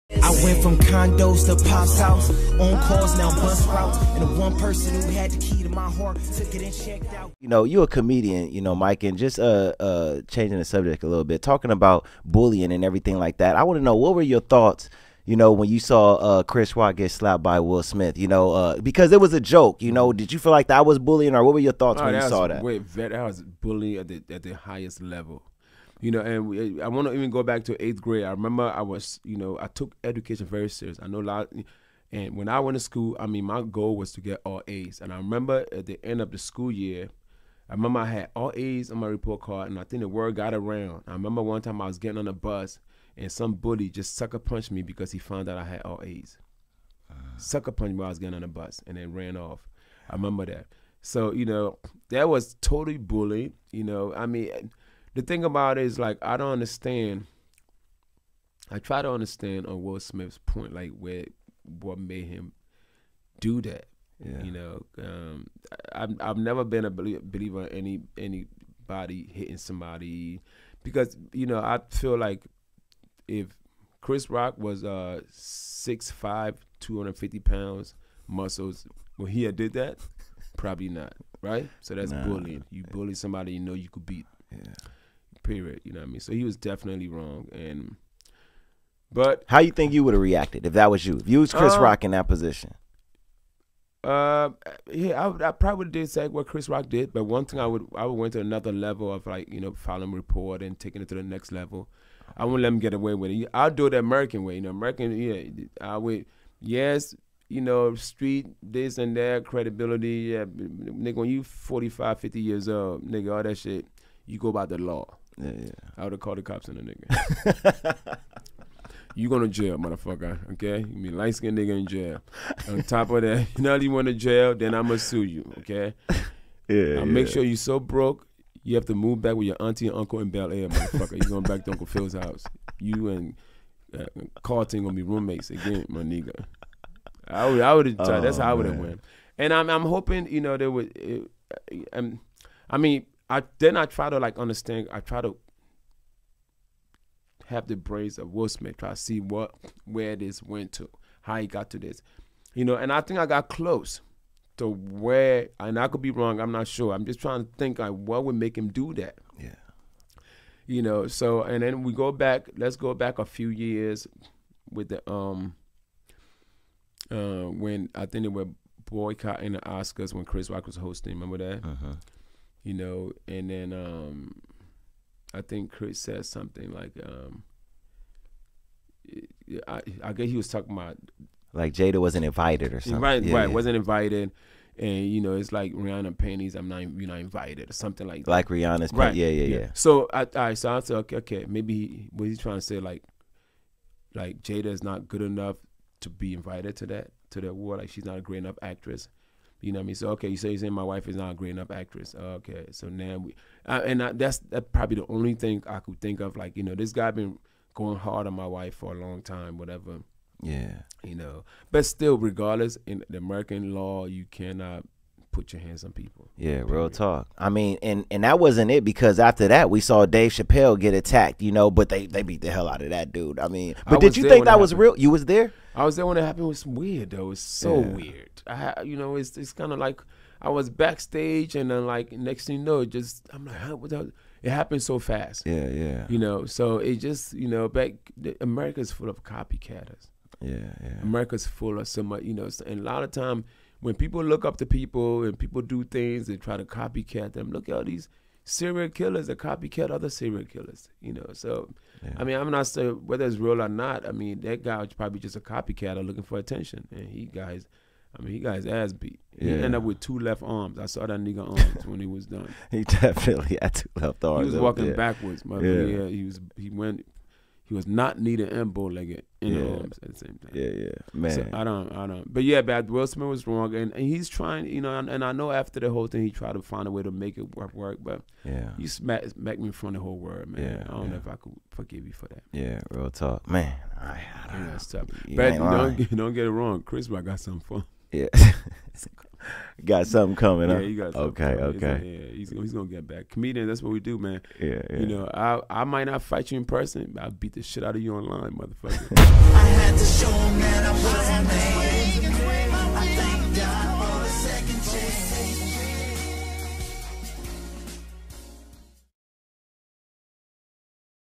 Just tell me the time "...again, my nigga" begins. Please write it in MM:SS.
02:15.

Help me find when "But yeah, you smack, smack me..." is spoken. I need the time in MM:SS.
04:38.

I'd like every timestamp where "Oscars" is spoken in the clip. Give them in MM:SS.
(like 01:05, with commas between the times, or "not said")
02:49.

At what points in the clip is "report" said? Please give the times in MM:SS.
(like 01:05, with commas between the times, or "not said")
00:39, 01:40.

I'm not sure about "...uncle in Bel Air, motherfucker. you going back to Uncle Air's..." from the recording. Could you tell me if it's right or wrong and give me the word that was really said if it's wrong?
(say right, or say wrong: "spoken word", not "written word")
wrong: "Phil", not "Air".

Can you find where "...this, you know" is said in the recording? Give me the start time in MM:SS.
02:31.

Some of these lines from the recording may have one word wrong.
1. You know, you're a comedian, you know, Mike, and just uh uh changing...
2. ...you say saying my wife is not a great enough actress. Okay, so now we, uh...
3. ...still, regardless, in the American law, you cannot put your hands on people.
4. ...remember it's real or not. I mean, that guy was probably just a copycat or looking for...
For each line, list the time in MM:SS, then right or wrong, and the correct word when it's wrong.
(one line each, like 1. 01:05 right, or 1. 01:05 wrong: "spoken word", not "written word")
1. 00:07 right
2. 03:20 right
3. 03:31 right
4. 04:13 wrong: "whether", not "remember".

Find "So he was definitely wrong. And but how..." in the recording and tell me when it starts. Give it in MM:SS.
01:26.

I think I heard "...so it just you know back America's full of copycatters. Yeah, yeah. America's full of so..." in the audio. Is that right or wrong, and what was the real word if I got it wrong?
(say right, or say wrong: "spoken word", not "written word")
right.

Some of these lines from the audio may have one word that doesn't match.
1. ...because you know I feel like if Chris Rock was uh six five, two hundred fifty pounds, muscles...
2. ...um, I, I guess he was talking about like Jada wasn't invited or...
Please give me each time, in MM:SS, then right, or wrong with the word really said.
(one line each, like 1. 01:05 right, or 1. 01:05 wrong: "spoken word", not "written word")
1. 01:10 right
2. 02:57 right.